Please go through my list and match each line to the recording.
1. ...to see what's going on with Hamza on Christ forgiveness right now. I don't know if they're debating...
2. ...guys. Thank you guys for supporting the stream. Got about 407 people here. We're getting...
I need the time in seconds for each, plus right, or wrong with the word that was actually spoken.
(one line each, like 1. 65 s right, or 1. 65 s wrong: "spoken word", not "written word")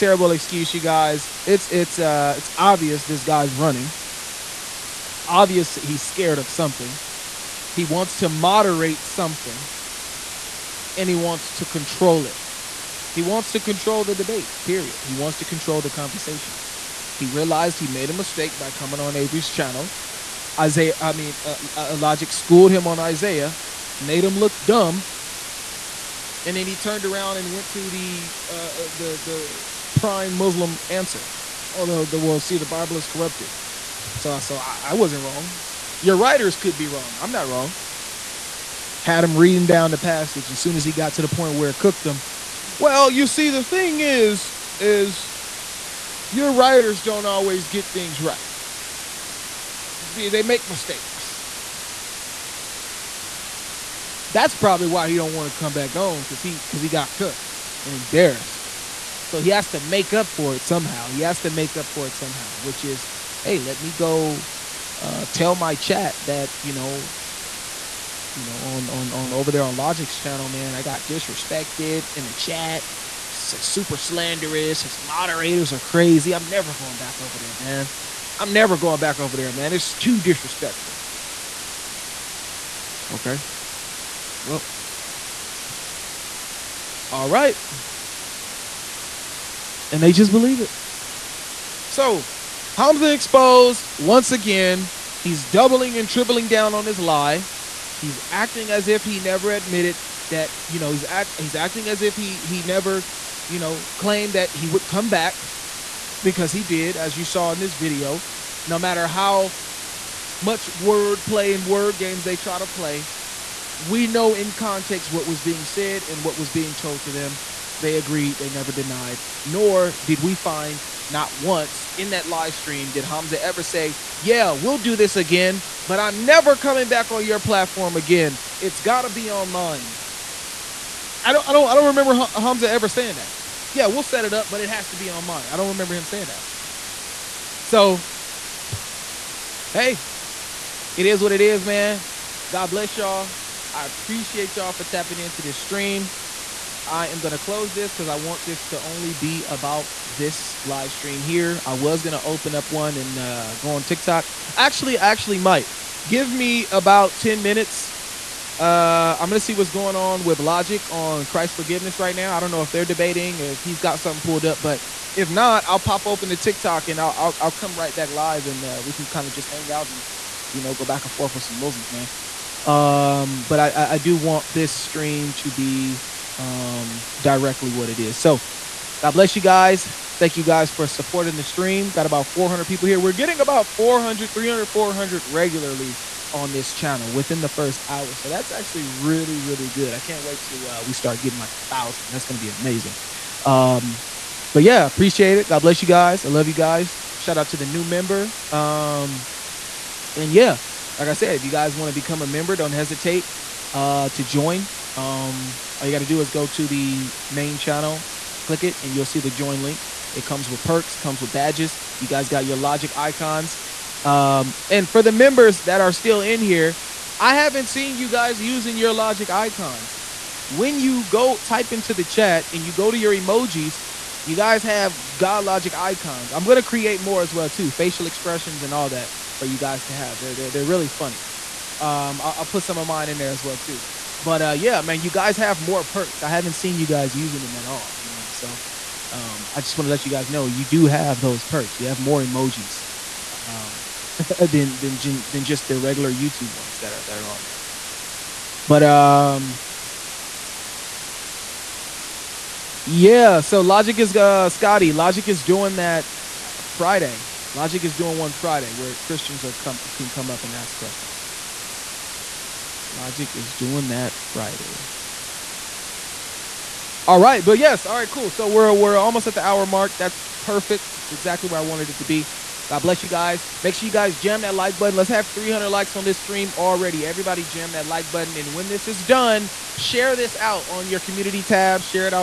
1. 159 s wrong: "Logic", not "Hamza"
2. 179 s wrong: "400", not "407".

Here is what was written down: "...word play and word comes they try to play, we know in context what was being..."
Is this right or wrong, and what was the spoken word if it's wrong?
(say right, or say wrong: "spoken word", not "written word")
wrong: "games", not "comes".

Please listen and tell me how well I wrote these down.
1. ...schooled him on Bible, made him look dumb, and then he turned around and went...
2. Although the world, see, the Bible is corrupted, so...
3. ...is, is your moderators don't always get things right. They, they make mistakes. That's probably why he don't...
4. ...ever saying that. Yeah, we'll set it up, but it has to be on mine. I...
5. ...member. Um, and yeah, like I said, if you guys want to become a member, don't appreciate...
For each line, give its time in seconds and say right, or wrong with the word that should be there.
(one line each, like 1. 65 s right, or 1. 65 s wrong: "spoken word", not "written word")
1. 22 s wrong: "Isaiah", not "Bible"
2. 31 s right
3. 44 s wrong: "writers", not "moderators"
4. 132 s right
5. 197 s wrong: "hesitate", not "appreciate".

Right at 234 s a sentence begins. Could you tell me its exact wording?
But uh, yeah, man, you guys have more perks.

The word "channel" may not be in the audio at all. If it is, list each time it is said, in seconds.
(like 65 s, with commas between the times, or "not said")
19 s, 70 s, 186 s, 207 s.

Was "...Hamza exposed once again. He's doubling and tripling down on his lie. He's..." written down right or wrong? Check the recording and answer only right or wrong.
right.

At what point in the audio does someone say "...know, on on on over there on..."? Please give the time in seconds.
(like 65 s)
68 s.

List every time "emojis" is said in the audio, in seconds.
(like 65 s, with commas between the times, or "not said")
223 s, 242 s.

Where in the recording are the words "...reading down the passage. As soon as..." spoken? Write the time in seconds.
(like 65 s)
39 s.